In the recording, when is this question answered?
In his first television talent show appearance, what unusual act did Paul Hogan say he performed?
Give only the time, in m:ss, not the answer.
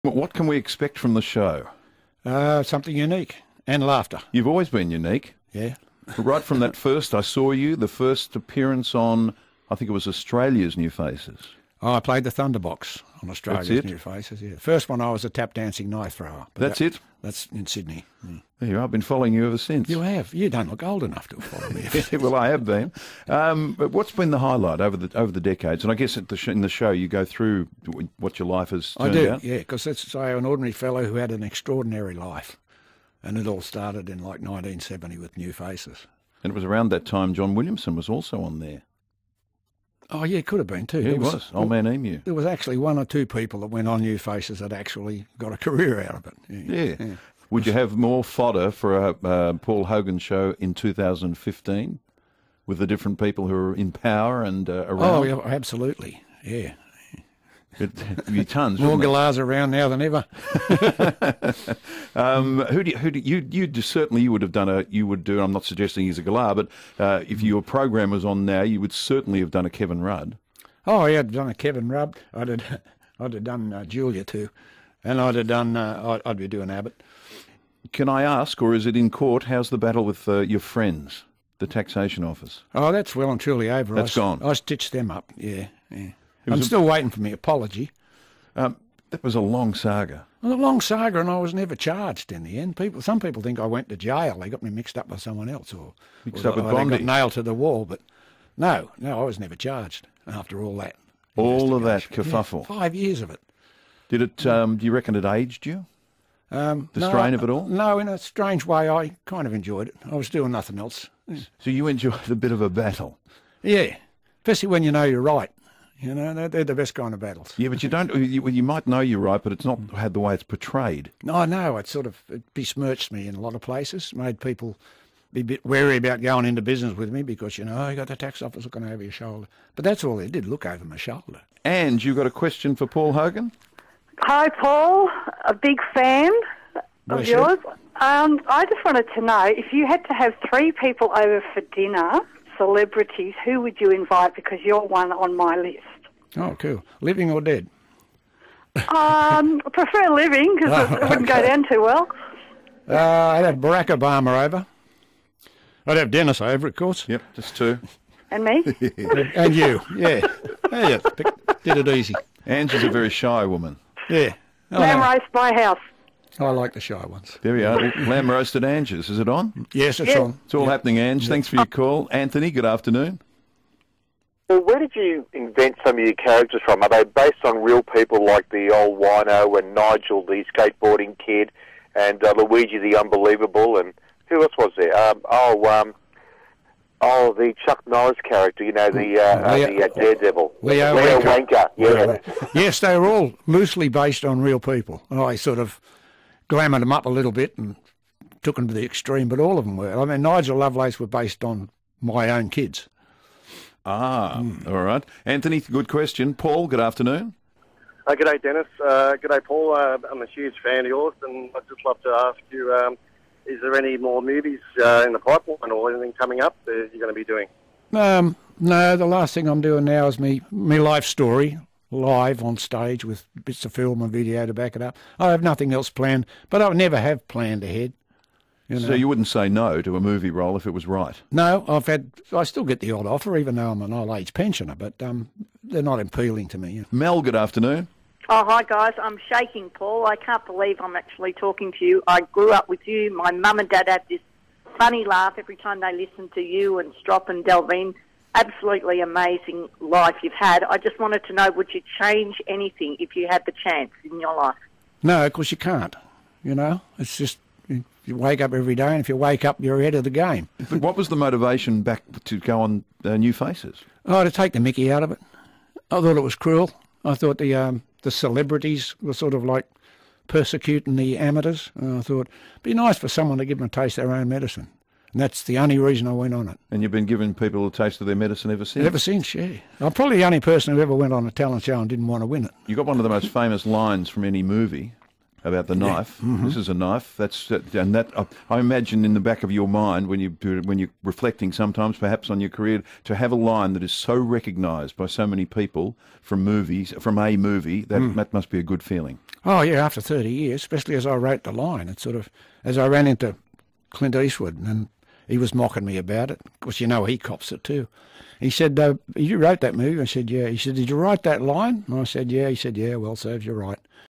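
0:15.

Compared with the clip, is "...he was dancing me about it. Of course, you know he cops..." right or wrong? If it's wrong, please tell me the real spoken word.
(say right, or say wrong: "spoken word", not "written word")
wrong: "mocking", not "dancing".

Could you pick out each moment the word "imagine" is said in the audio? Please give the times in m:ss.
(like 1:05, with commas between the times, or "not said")
4:48.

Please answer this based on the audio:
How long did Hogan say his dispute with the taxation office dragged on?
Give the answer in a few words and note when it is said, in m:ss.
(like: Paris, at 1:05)
5 years, at 1:42.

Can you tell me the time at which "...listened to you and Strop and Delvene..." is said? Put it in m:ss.
4:05.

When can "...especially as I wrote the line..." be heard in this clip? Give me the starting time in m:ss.
5:00.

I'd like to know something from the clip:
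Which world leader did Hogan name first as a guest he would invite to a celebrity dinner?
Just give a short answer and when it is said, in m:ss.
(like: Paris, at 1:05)
Barack Obama, at 2:33.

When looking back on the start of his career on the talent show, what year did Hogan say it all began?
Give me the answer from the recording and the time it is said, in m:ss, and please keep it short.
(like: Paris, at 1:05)
1970, at 0:34.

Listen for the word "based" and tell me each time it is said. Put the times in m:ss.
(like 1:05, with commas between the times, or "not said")
2:57, 3:13, 3:21.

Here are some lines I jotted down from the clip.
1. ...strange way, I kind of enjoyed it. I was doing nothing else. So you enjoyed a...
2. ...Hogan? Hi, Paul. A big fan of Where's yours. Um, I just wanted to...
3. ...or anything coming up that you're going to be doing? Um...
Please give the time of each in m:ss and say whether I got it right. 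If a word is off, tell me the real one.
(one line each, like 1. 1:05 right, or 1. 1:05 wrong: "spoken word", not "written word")
1. 1:48 right
2. 2:13 right
3. 3:35 right.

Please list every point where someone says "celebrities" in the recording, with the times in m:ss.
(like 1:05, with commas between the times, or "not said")
2:22, 4:28.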